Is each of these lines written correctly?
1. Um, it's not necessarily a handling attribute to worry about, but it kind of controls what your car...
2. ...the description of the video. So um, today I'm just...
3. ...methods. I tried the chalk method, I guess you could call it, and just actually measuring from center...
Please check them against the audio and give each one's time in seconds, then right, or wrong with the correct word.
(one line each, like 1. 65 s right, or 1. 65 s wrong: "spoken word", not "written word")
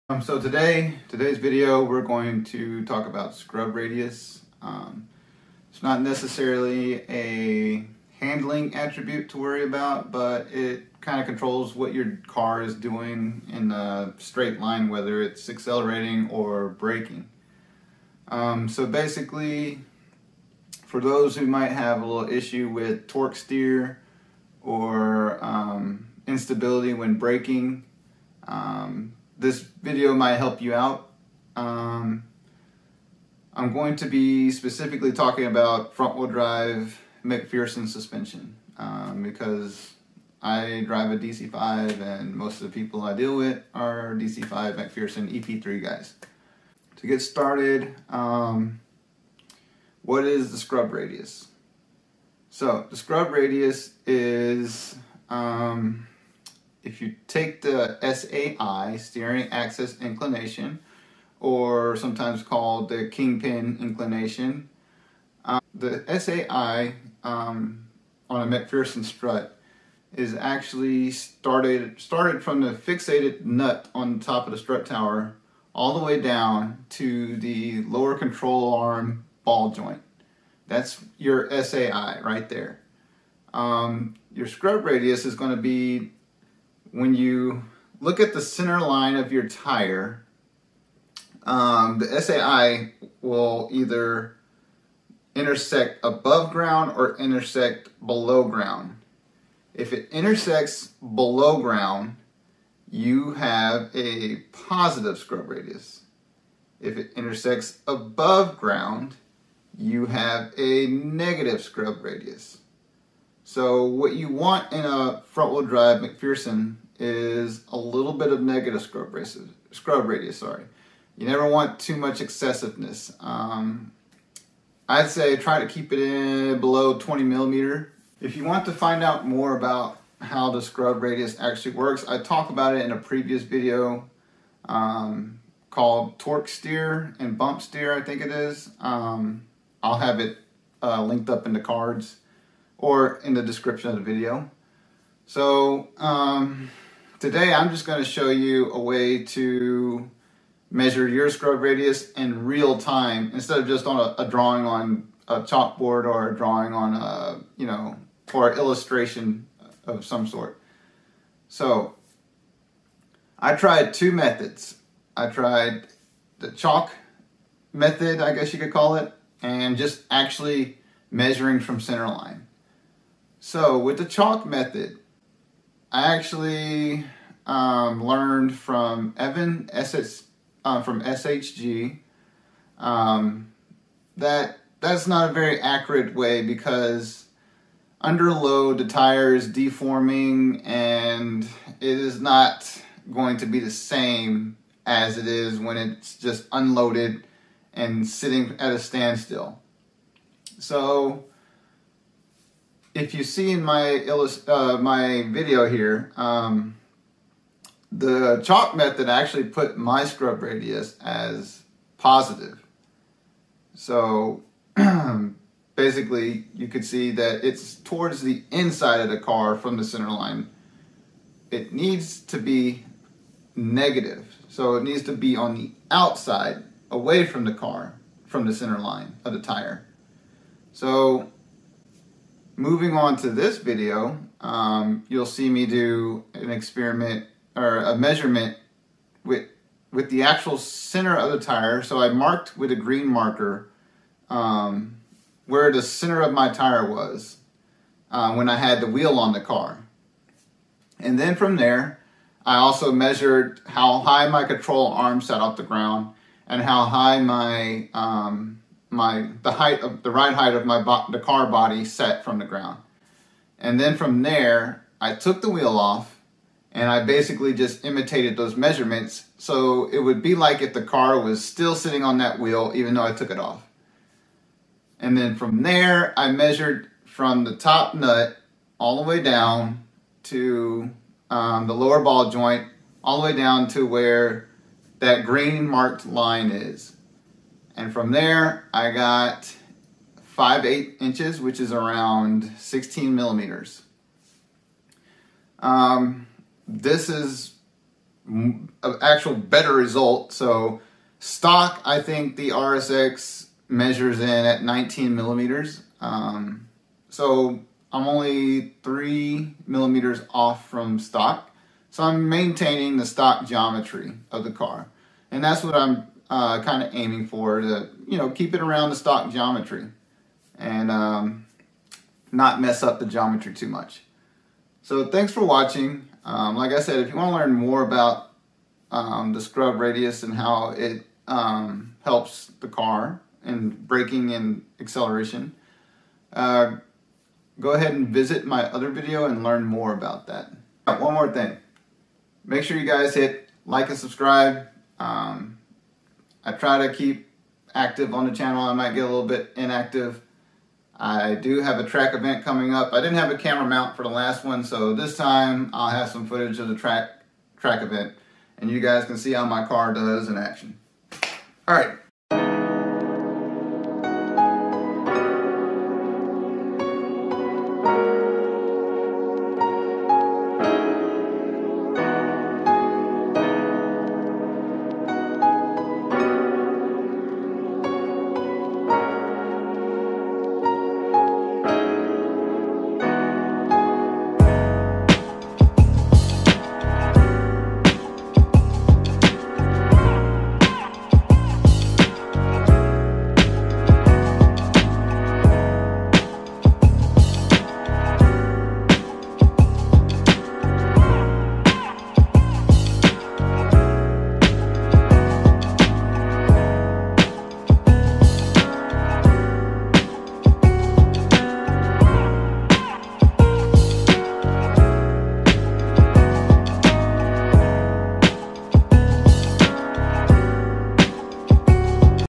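1. 4 s right
2. 143 s right
3. 164 s right.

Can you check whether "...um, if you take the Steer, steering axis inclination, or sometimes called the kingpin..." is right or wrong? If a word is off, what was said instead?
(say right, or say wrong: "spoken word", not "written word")
wrong: "SAI", not "Steer".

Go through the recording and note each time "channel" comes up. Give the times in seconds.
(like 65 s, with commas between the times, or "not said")
348 s.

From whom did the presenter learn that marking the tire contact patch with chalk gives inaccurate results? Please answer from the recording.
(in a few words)
Evan SS.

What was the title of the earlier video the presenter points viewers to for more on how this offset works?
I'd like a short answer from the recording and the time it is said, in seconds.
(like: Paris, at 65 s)
Torque Steer and Bump Steer, at 136 s.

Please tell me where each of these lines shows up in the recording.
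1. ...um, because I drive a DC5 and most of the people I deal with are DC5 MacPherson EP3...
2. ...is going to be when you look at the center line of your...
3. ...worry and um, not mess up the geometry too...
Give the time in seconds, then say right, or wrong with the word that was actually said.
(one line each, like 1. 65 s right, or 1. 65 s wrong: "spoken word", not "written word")
1. 38 s right
2. 85 s right
3. 319 s wrong: "geometry", not "worry".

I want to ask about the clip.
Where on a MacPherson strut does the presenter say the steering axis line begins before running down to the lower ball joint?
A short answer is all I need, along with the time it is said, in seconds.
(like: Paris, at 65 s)
fixated nut on the top of the strut tower, at 72 s.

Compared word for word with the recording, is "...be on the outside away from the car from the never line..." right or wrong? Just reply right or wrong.
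wrong.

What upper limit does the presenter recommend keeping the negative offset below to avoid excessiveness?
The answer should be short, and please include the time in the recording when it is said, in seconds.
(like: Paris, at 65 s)
20 millimeters, at 126 s.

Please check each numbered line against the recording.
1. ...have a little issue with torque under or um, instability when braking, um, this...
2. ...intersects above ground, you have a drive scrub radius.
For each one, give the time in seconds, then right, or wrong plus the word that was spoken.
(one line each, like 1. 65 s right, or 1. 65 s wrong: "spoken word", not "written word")
1. 21 s wrong: "steer", not "under"
2. 107 s wrong: "negative", not "drive".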